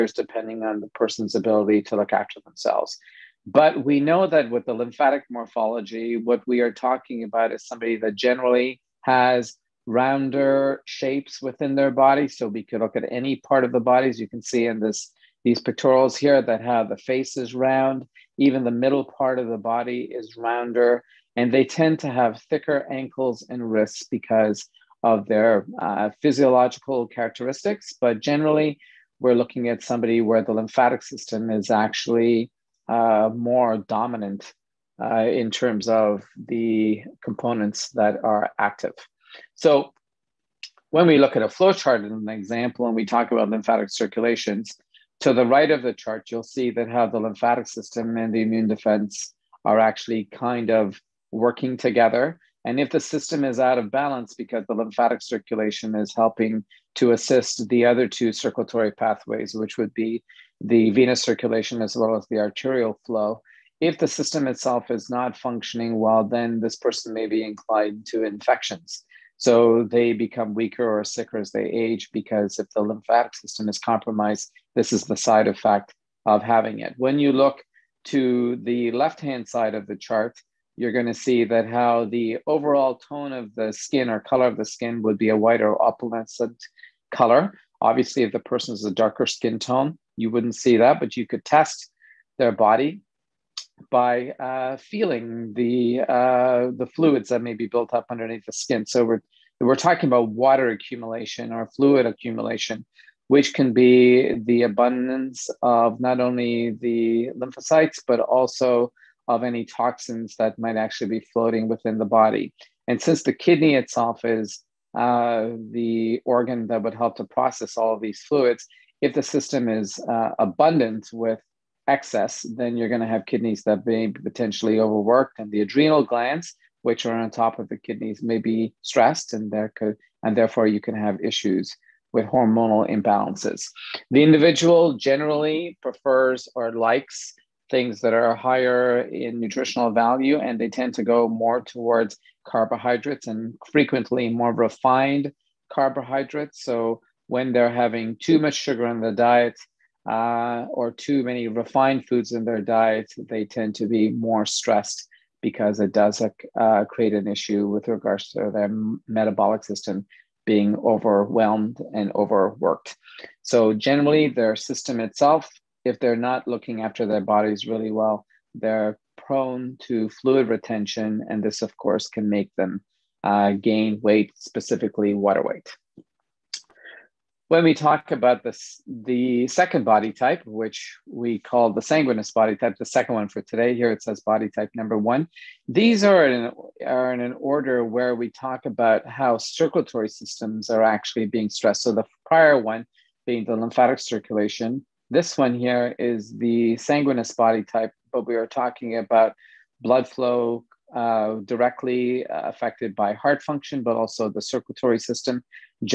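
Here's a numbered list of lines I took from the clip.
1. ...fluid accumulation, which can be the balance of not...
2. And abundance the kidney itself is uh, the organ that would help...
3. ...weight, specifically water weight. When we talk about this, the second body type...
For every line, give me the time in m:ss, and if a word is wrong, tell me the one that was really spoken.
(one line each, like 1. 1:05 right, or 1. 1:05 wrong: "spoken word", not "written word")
1. 1:41 wrong: "abundance", not "balance"
2. 1:52 wrong: "since", not "abundance"
3. 2:54 right.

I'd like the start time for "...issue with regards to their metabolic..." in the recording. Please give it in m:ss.
2:37.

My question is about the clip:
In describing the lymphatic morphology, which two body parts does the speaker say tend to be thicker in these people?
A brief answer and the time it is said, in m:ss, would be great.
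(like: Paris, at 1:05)
Ankles and wrists, at 0:22.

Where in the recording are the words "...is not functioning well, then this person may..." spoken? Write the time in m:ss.
1:04.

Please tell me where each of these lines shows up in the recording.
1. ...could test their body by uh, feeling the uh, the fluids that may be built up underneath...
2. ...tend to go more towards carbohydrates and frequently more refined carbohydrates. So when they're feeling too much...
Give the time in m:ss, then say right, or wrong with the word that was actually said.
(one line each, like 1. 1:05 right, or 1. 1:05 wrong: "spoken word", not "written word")
1. 1:31 right
2. 2:20 wrong: "having", not "feeling".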